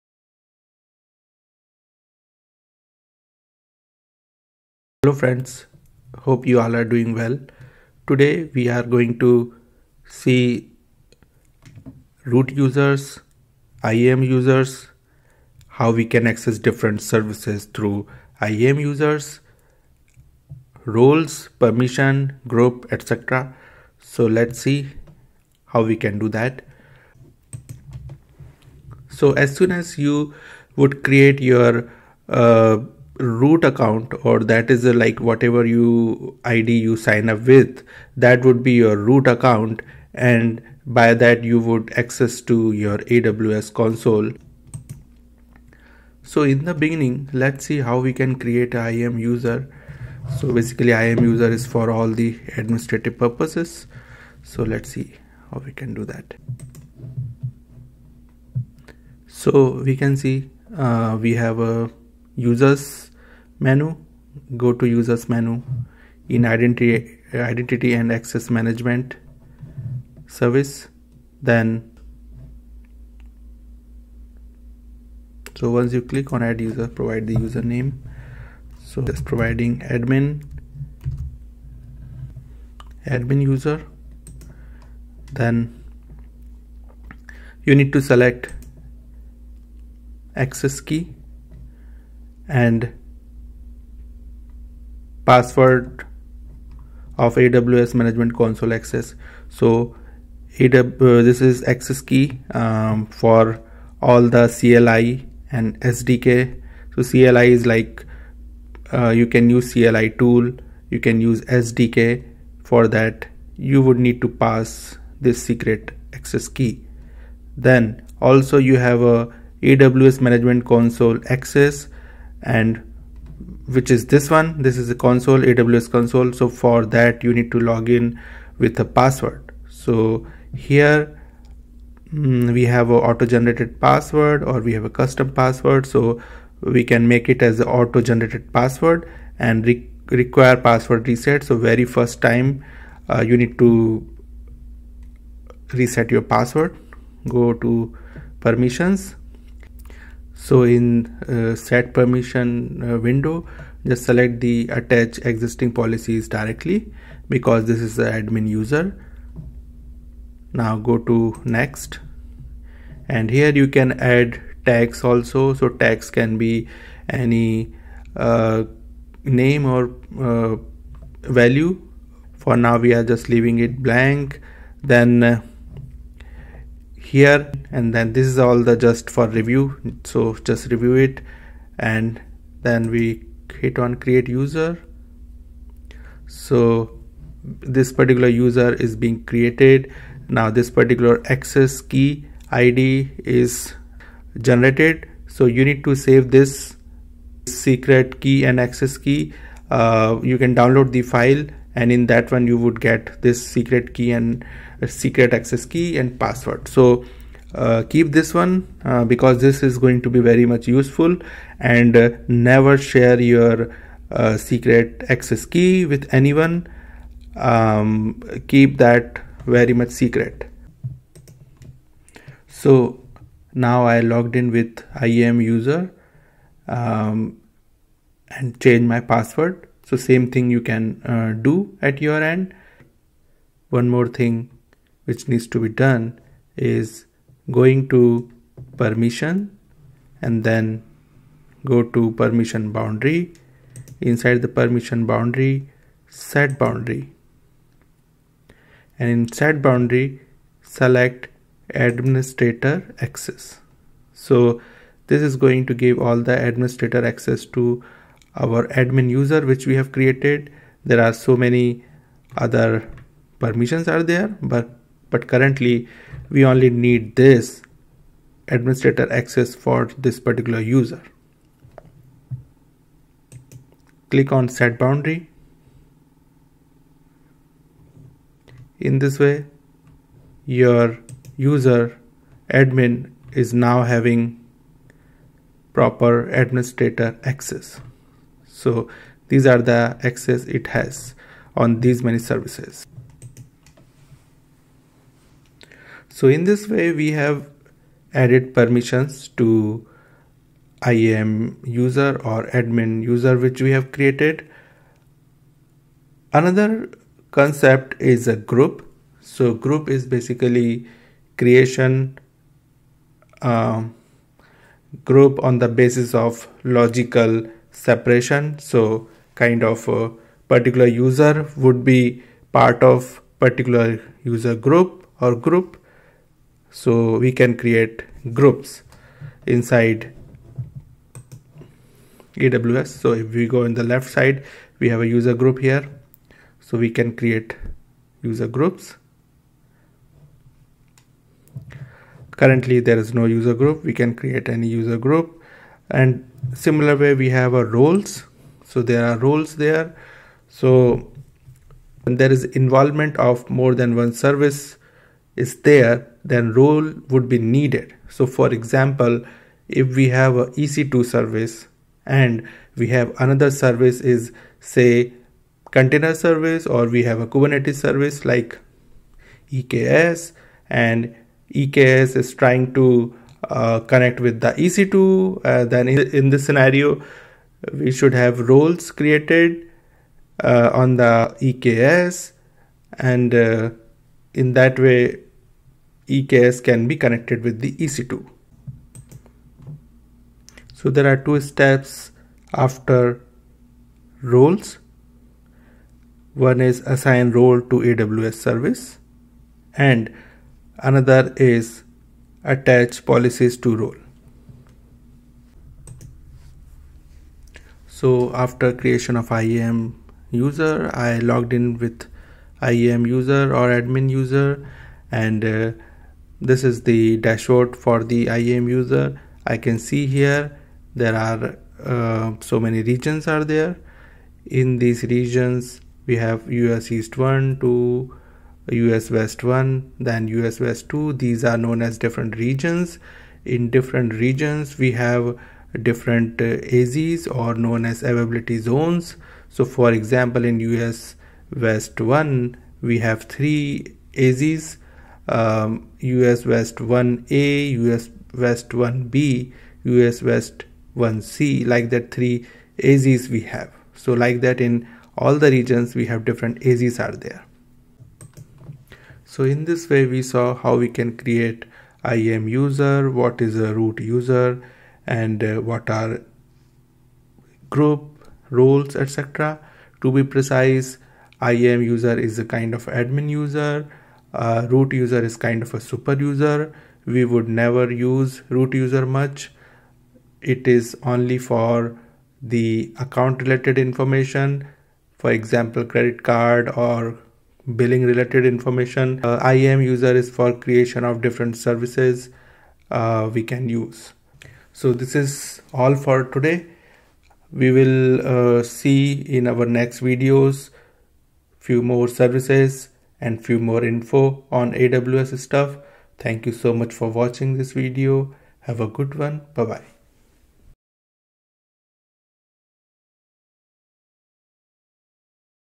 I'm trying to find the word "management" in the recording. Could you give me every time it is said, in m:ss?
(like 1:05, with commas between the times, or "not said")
1:08, 1:37, 2:00.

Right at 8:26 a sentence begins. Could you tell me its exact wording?
Thank you so much for watching this video.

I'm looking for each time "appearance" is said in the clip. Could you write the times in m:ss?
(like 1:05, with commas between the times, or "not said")
not said.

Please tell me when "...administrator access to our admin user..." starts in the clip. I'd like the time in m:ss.
4:16.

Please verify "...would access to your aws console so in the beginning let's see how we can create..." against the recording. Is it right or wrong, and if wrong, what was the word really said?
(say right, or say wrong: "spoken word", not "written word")
right.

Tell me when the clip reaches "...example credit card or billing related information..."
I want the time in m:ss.
8:05.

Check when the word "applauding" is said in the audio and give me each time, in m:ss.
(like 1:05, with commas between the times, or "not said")
not said.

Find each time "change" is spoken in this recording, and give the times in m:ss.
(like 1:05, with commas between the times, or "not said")
3:48.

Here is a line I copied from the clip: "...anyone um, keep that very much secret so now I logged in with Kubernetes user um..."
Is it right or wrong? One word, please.
wrong.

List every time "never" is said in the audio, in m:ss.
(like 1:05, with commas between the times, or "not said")
3:32, 7:57.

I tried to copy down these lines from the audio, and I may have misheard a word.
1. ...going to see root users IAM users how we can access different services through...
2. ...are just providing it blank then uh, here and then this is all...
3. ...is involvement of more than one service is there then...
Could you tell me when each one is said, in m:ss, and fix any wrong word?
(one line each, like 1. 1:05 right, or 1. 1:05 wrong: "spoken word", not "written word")
1. 0:08 right
2. 2:52 wrong: "leaving", not "providing"
3. 5:52 right.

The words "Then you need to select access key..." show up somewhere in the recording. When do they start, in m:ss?
1:25.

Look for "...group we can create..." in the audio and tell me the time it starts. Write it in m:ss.
5:43.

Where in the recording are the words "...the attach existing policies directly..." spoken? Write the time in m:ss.
2:34.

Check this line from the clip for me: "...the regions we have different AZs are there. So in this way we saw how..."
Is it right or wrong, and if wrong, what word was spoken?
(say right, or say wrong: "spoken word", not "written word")
right.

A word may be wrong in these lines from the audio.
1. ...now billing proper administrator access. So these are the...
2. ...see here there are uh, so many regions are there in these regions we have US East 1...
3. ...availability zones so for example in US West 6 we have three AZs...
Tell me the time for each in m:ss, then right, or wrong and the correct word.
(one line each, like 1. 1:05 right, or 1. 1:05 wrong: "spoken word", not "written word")
1. 4:43 wrong: "having", not "billing"
2. 6:59 right
3. 7:18 wrong: "1", not "6".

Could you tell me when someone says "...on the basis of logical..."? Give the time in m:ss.
5:15.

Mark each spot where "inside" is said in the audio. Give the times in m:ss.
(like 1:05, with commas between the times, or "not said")
4:03, 5:29.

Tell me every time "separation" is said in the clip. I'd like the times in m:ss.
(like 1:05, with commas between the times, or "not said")
5:17.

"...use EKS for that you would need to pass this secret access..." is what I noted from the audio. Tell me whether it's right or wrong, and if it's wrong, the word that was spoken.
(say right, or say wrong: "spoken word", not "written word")
wrong: "SDK", not "EKS".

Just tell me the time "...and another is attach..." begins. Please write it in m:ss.
6:39.